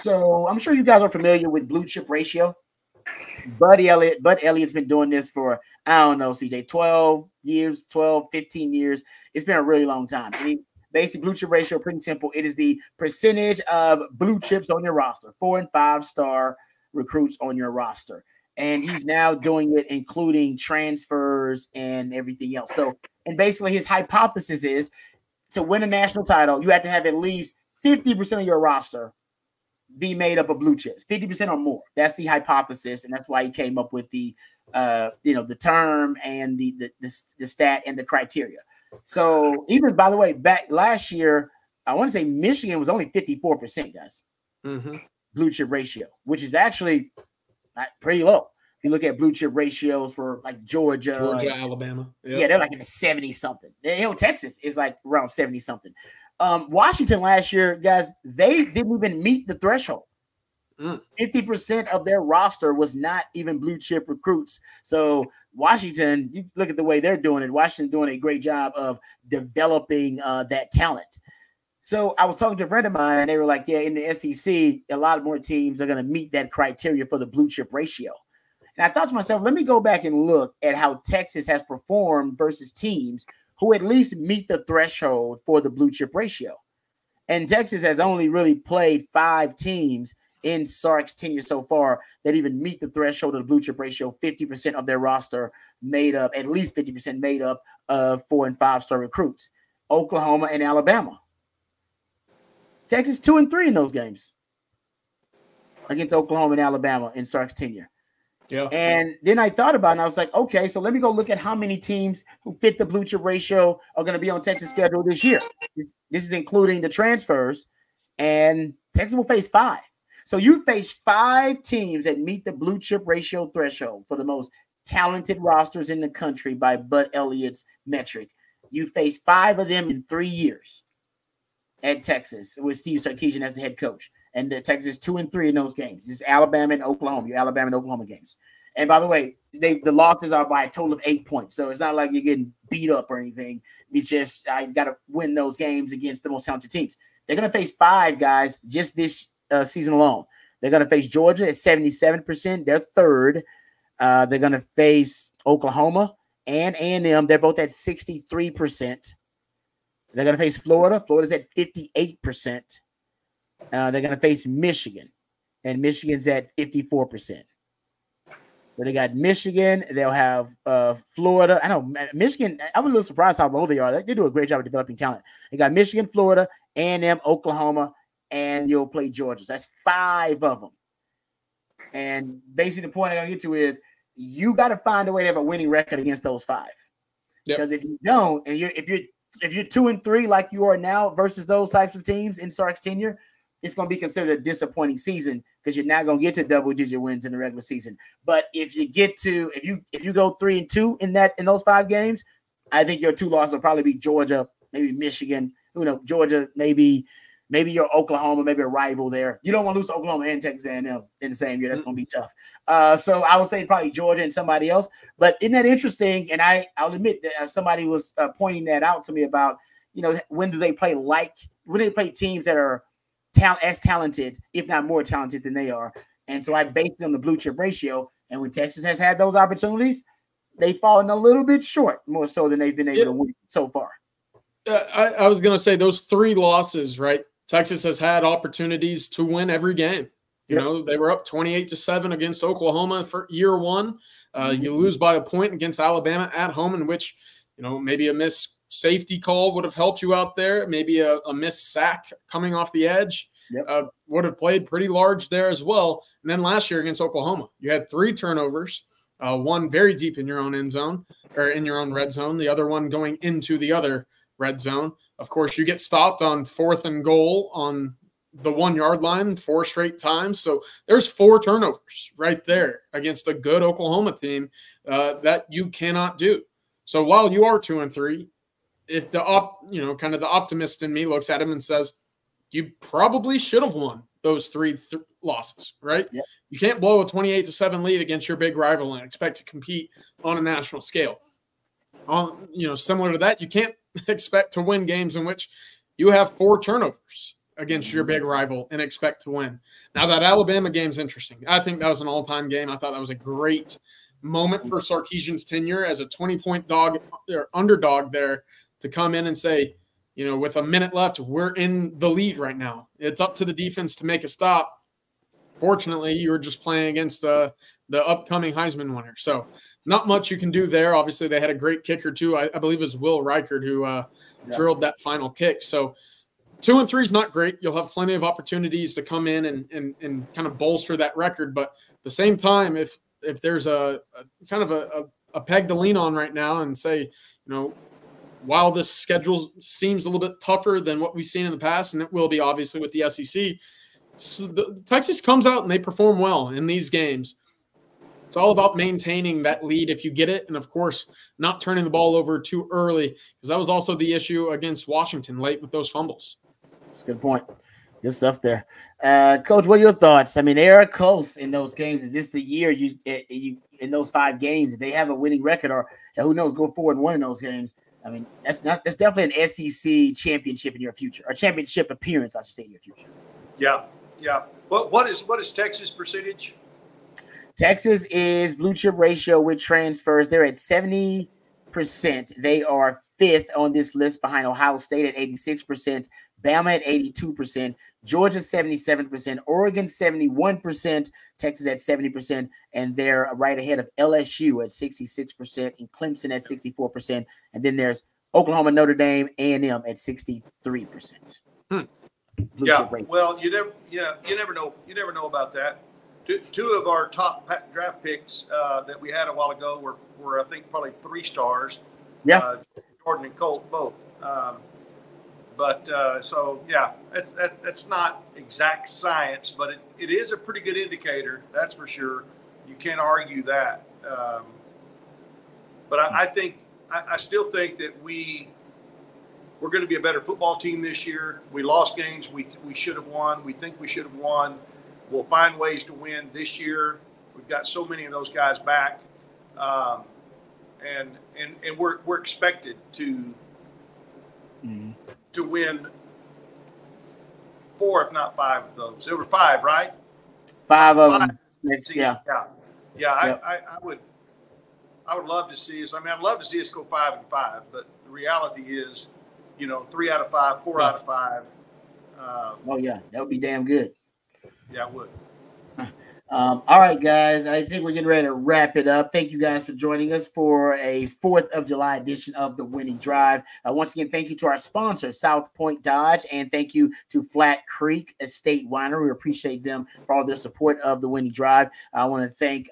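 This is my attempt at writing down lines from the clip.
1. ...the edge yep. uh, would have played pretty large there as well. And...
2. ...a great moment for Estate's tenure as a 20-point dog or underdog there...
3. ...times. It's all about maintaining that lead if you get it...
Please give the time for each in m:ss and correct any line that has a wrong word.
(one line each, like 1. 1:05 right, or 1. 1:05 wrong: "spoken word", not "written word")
1. 4:12 right
2. 5:03 wrong: "Sarkisian", not "Estate"
3. 5:46 wrong: "games", not "times".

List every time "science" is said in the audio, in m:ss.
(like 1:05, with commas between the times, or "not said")
6:58.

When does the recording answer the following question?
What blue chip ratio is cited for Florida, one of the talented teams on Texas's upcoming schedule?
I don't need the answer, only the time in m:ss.
2:41.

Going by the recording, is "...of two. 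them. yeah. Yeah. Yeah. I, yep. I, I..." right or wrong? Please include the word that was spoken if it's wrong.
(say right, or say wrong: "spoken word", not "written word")
wrong: "five", not "two".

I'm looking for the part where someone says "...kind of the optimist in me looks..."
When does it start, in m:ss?
4:39.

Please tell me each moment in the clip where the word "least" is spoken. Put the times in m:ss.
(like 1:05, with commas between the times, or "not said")
0:27, 1:23, 1:36.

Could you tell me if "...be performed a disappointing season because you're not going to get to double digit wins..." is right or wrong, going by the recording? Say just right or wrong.
wrong.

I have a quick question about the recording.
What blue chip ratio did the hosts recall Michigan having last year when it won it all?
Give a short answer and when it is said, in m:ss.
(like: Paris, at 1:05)
54%, at 0:43.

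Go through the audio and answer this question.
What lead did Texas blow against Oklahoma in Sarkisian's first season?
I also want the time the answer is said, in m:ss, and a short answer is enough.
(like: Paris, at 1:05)
28 to 7, at 4:01.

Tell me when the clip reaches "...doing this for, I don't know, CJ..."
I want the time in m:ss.
0:04.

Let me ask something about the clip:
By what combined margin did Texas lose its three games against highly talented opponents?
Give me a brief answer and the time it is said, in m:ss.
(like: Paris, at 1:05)
8 points, at 2:21.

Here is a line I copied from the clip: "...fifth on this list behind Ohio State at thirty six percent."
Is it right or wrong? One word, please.
wrong.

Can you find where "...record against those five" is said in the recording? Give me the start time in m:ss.
3:05.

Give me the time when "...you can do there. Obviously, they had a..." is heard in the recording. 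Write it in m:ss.
5:20.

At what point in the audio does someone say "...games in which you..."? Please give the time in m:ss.
4:54.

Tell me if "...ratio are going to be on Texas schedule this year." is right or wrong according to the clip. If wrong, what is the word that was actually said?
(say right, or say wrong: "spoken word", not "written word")
right.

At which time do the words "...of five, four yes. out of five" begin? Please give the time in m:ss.
7:40.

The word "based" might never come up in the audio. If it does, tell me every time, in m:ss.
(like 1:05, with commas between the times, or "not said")
3:46.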